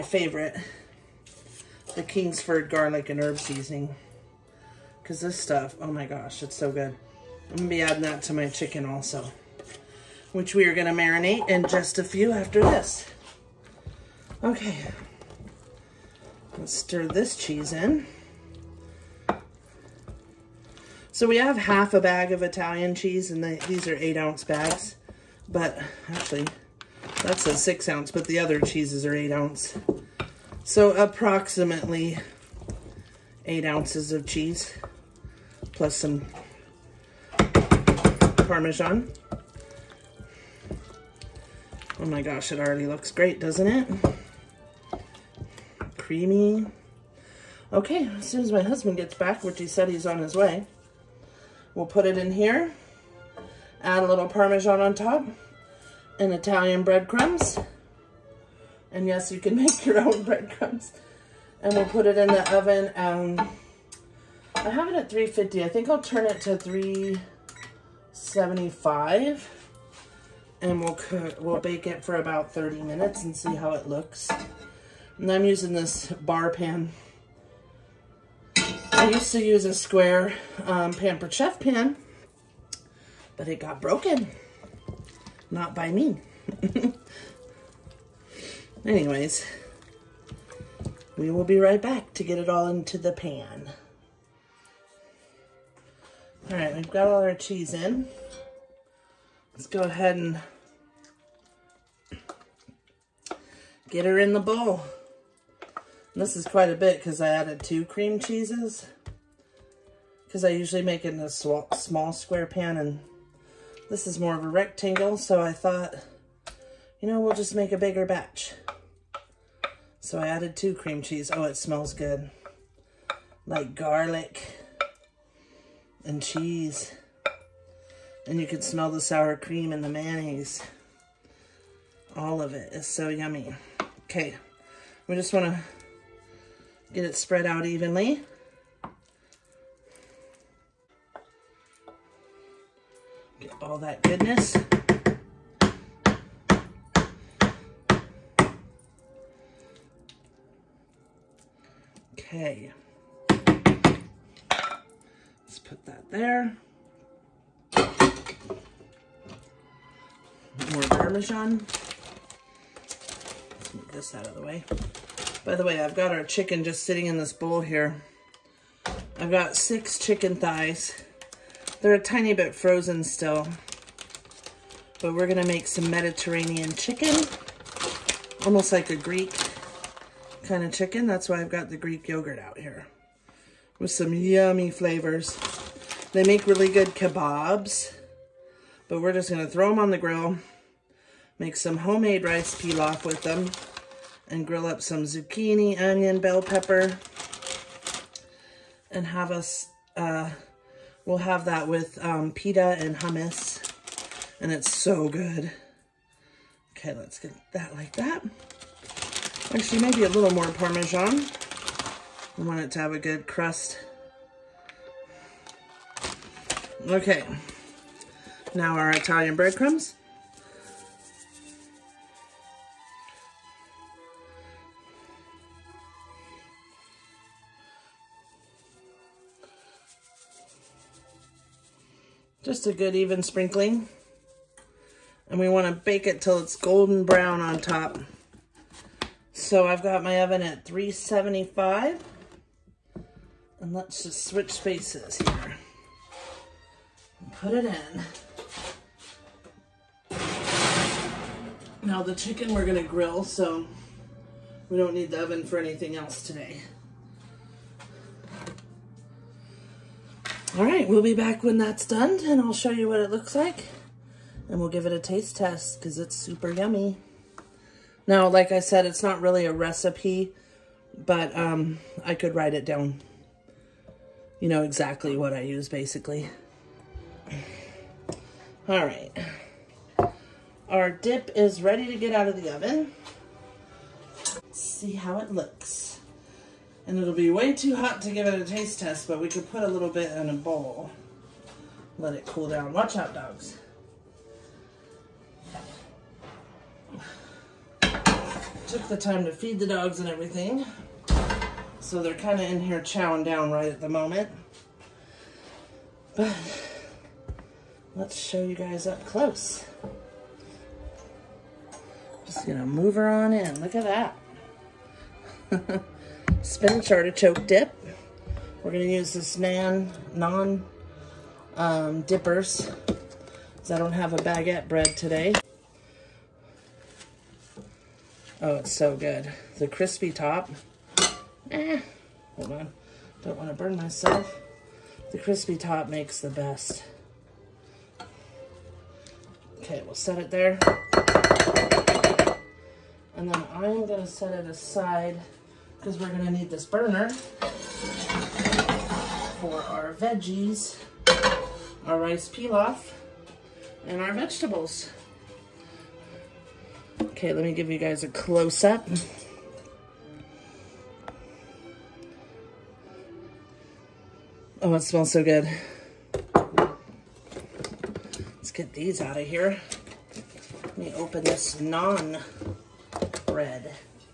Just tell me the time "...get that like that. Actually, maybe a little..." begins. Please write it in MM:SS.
03:27.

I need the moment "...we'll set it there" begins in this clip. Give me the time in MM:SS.
05:39.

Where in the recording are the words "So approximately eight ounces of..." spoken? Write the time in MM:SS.
00:30.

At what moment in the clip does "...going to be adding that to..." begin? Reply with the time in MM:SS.
00:07.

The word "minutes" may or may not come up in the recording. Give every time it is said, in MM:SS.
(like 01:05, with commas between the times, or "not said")
01:12.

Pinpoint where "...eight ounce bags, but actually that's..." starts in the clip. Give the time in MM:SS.
00:23.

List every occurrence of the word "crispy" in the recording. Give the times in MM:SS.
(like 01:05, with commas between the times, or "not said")
05:29, 05:35.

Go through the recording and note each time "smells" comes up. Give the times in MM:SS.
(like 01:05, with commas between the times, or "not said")
02:01, 02:08, 06:04.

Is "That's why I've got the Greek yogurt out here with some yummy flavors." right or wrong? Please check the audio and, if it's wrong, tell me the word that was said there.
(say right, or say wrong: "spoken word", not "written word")
right.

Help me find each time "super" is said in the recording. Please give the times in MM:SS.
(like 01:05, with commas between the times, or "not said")
04:26.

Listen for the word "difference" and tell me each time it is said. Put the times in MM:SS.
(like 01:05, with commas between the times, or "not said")
not said.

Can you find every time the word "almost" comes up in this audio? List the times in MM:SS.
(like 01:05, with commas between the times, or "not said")
02:58.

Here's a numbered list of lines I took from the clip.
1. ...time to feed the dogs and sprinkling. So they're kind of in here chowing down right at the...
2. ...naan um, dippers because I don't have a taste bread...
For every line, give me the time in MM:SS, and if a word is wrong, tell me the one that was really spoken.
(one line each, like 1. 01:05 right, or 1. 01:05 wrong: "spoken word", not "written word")
1. 04:58 wrong: "everything", not "sprinkling"
2. 05:20 wrong: "baguette", not "taste".